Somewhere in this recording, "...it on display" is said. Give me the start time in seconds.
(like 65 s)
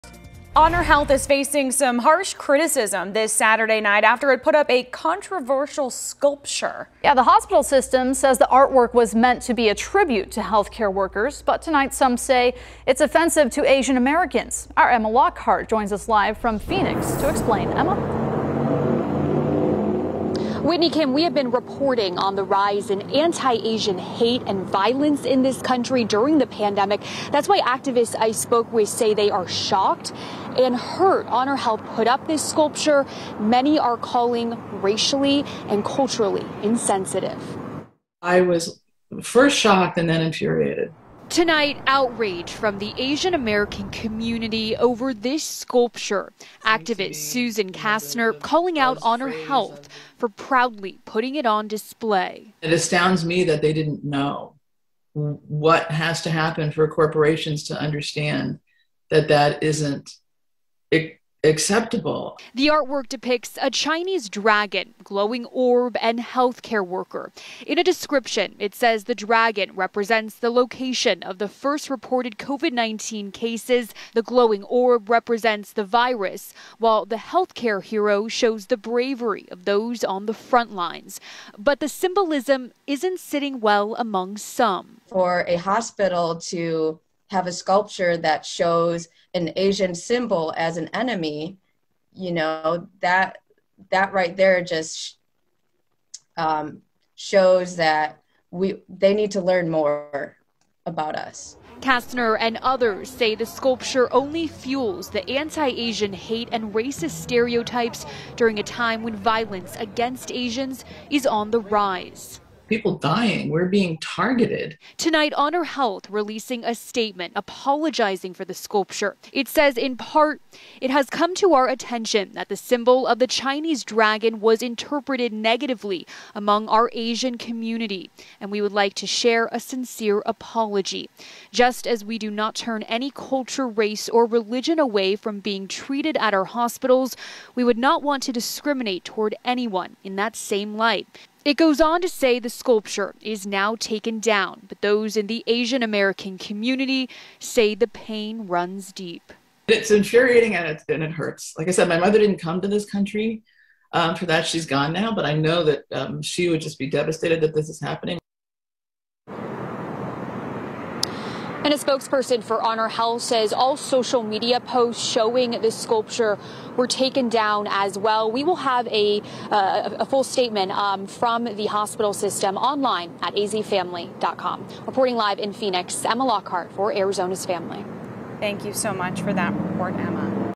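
51 s.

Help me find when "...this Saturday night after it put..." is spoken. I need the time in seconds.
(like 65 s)
3 s.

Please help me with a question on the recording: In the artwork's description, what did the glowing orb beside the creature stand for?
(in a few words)
the virus.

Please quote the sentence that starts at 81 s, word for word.
But the symbolism isn't sitting well among some.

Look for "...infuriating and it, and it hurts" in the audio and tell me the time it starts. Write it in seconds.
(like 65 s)
149 s.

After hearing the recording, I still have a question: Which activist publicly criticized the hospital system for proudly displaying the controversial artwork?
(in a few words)
Susan Kastner.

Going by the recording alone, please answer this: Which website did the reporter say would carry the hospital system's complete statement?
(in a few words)
azfamily.com.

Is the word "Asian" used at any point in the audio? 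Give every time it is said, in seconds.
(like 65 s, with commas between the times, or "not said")
13 s, 23 s, 42 s, 89 s, 105 s, 110 s, 126 s, 145 s.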